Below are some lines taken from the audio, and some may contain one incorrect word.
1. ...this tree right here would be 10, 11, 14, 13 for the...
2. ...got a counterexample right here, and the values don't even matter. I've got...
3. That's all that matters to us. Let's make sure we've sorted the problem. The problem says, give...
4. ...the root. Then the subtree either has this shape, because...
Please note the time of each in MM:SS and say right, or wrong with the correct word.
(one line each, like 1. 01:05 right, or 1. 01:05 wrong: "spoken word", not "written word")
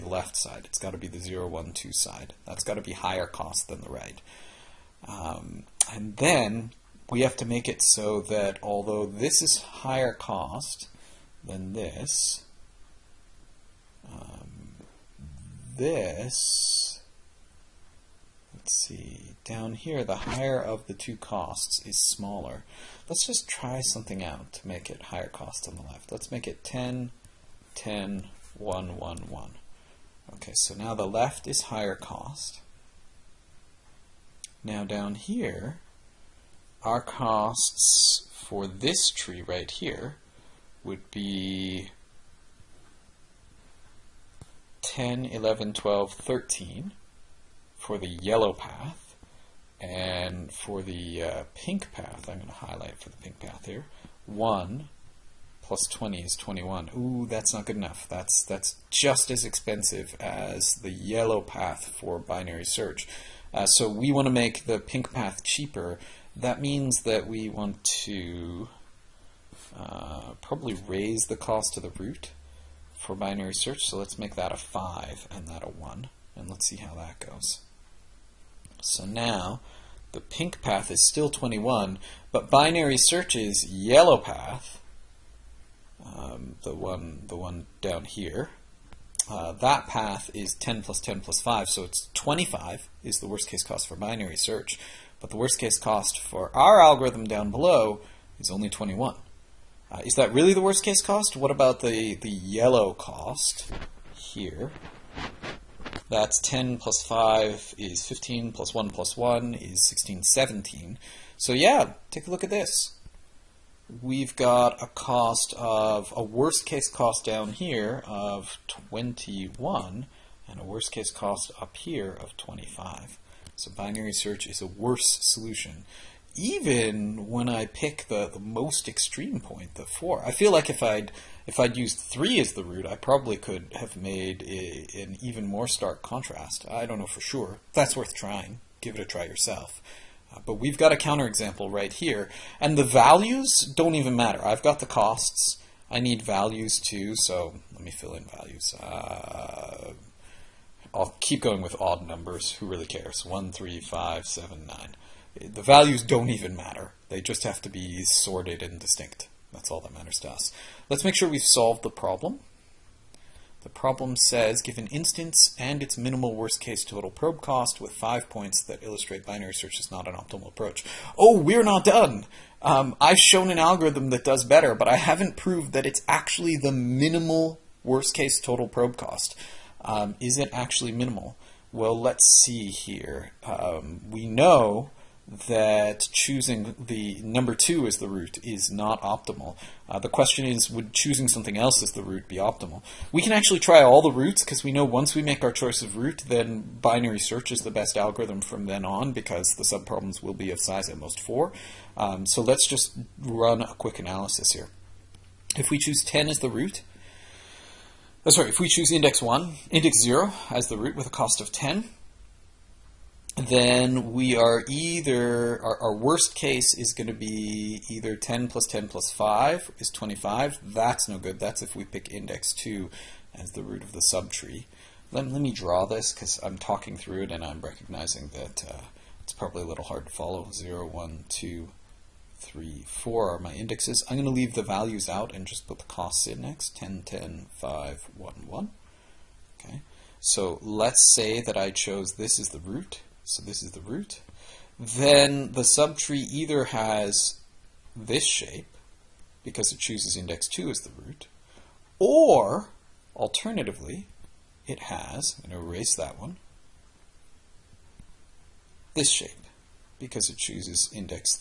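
1. 00:38 wrong: "12", not "14"
2. 02:20 right
3. 02:39 wrong: "solved", not "sorted"
4. 04:03 right.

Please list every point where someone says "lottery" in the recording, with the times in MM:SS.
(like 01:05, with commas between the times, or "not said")
not said.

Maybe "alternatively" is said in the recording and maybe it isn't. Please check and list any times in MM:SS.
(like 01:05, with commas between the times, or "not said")
04:13.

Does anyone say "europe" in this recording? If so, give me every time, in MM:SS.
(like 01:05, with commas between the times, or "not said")
not said.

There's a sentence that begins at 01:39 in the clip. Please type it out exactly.
Uh, is that really the worst case cost?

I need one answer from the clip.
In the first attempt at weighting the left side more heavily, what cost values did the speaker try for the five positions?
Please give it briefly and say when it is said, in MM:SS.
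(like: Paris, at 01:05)
10, 10, 1, 1, 1, at 00:26.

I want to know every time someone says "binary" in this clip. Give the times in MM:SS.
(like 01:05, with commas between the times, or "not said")
01:02, 01:13, 01:22, 01:33, 02:03, 02:49, 03:16.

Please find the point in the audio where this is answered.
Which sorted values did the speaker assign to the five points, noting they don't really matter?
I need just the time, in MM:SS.
02:33.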